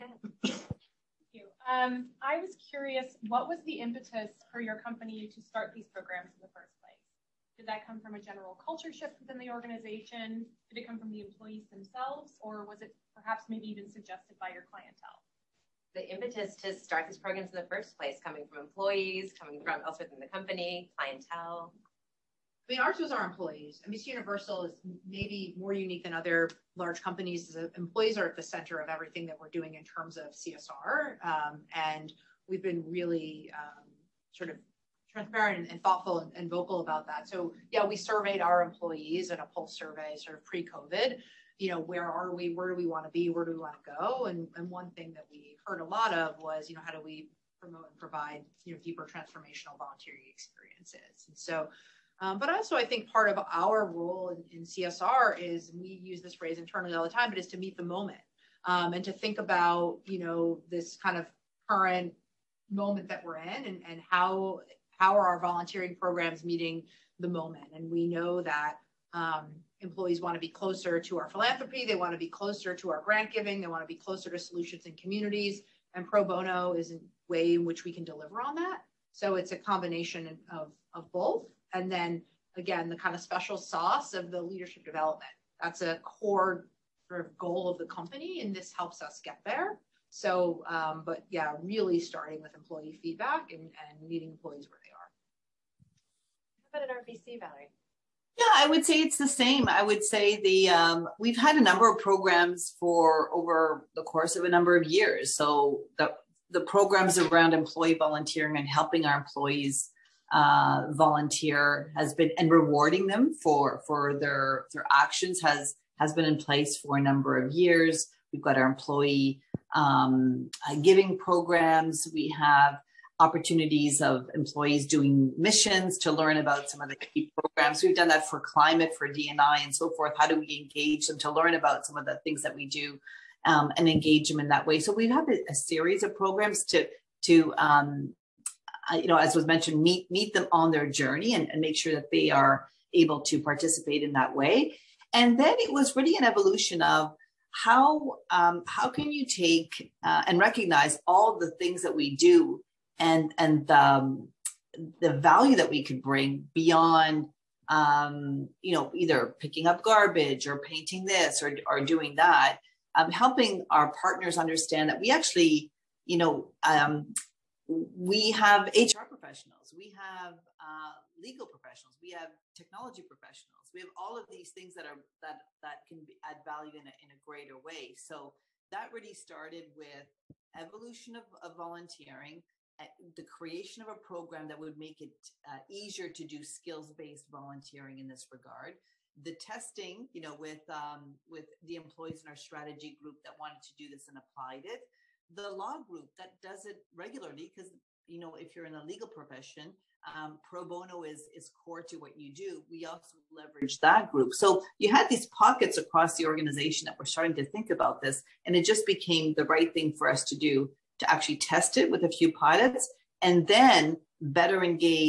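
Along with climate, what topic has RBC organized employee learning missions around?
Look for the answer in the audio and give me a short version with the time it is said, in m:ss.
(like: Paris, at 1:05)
DNI, at 2:09.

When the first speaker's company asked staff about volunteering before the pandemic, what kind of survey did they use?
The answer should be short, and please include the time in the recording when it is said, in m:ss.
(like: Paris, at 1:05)
pulse survey, at 0:39.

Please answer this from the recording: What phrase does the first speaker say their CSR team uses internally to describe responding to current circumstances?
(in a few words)
meet the moment.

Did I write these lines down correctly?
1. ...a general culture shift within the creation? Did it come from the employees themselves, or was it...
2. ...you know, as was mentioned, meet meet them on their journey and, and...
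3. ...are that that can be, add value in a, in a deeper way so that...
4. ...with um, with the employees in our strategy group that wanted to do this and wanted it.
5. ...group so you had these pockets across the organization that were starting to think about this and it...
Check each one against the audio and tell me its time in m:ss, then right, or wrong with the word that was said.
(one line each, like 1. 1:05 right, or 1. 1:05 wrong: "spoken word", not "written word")
1. 0:08 wrong: "organization", not "creation"
2. 2:18 right
3. 2:54 wrong: "greater", not "deeper"
4. 3:10 wrong: "applied", not "wanted"
5. 3:24 right.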